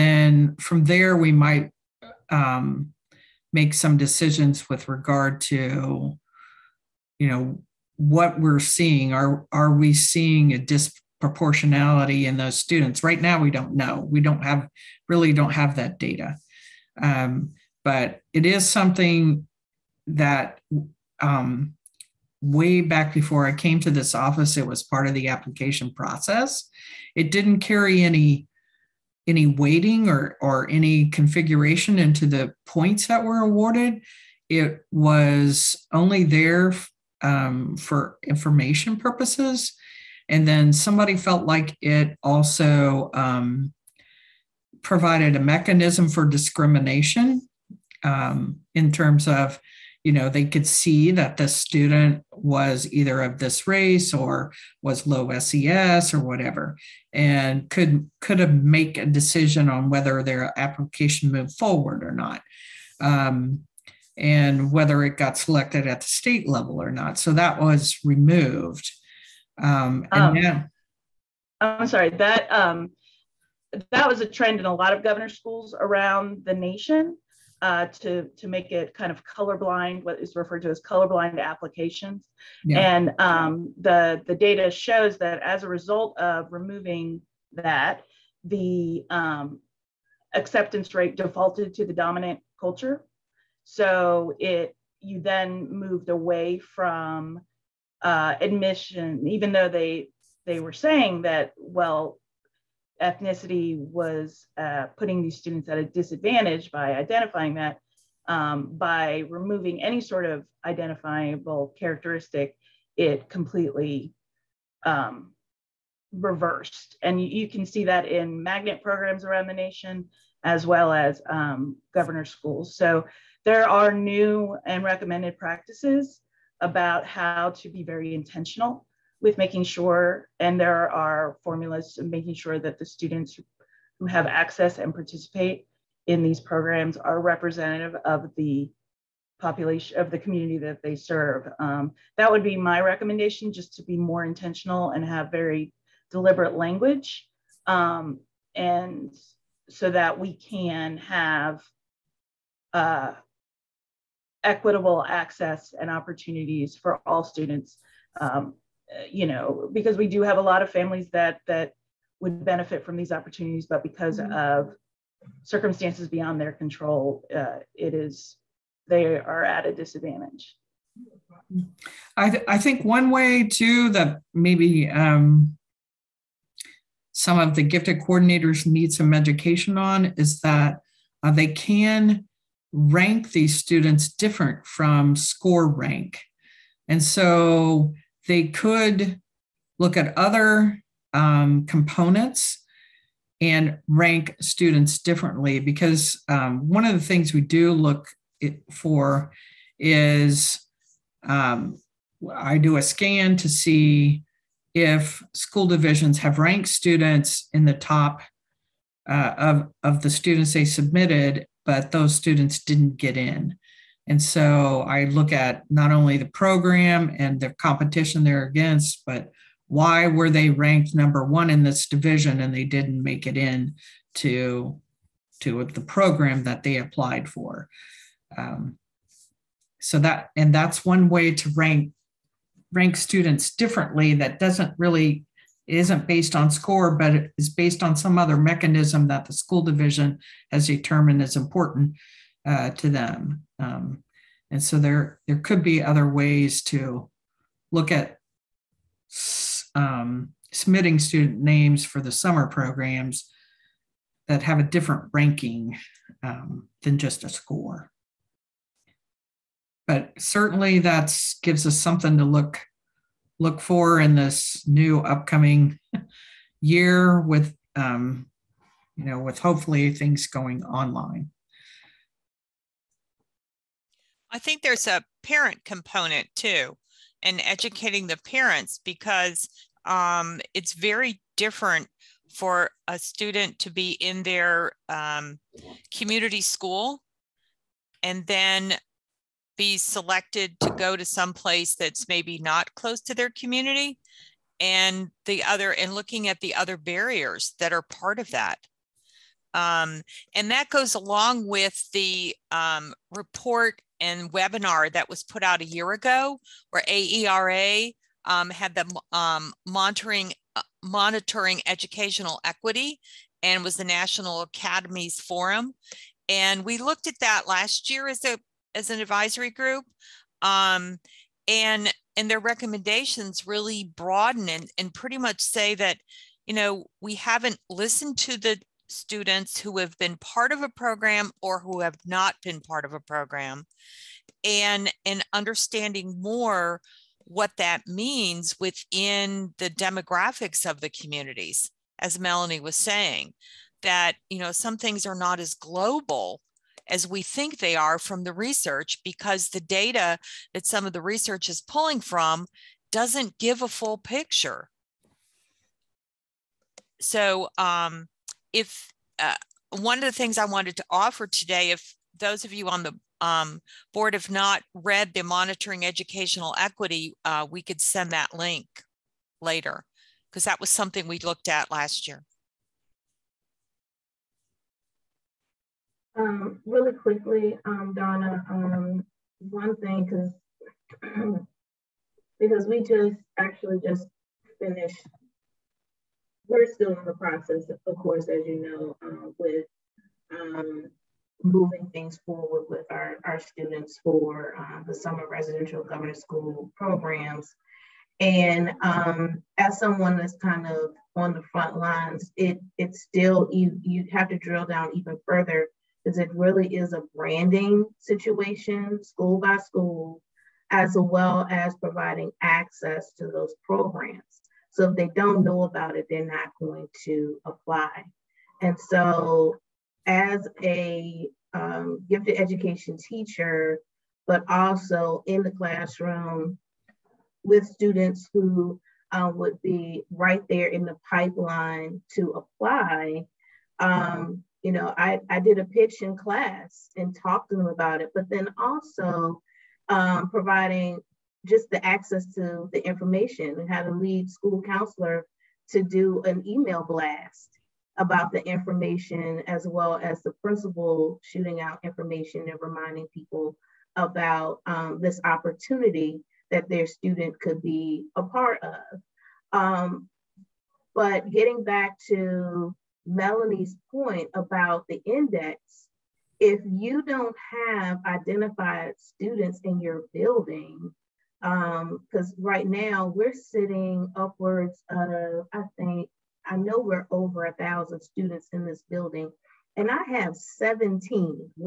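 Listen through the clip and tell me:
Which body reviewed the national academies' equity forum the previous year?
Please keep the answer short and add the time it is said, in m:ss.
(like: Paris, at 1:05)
advisory group, at 5:18.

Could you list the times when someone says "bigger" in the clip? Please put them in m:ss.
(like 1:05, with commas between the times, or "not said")
not said.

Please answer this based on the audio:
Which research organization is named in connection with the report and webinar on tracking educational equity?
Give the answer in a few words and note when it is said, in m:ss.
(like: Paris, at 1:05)
AERA, at 5:06.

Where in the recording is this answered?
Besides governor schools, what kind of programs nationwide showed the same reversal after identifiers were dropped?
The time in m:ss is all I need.
1:58.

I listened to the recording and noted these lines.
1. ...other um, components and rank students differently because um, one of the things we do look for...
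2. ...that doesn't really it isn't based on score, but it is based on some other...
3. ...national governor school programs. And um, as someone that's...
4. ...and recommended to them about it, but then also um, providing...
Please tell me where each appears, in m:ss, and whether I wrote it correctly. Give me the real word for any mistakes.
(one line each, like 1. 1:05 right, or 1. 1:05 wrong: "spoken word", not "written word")
1. 3:10 right
2. 3:54 right
3. 6:35 wrong: "residential", not "national"
4. 7:16 wrong: "talked", not "recommended".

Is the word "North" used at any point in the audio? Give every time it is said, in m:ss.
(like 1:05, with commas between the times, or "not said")
not said.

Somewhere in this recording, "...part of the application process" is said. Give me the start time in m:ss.
0:24.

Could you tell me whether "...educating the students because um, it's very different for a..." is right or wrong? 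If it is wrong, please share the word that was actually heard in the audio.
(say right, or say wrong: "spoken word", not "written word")
wrong: "parents", not "students".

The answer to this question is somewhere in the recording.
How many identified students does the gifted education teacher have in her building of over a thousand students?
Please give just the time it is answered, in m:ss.
8:00.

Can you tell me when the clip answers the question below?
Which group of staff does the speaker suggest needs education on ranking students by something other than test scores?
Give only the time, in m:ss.
2:57.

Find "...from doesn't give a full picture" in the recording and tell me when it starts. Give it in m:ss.
5:51.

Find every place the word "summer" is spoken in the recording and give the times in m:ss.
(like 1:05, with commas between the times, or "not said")
4:12, 6:34.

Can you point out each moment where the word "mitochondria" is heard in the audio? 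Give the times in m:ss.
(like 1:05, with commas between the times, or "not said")
not said.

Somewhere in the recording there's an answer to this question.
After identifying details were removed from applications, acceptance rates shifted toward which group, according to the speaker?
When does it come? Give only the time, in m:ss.
1:31.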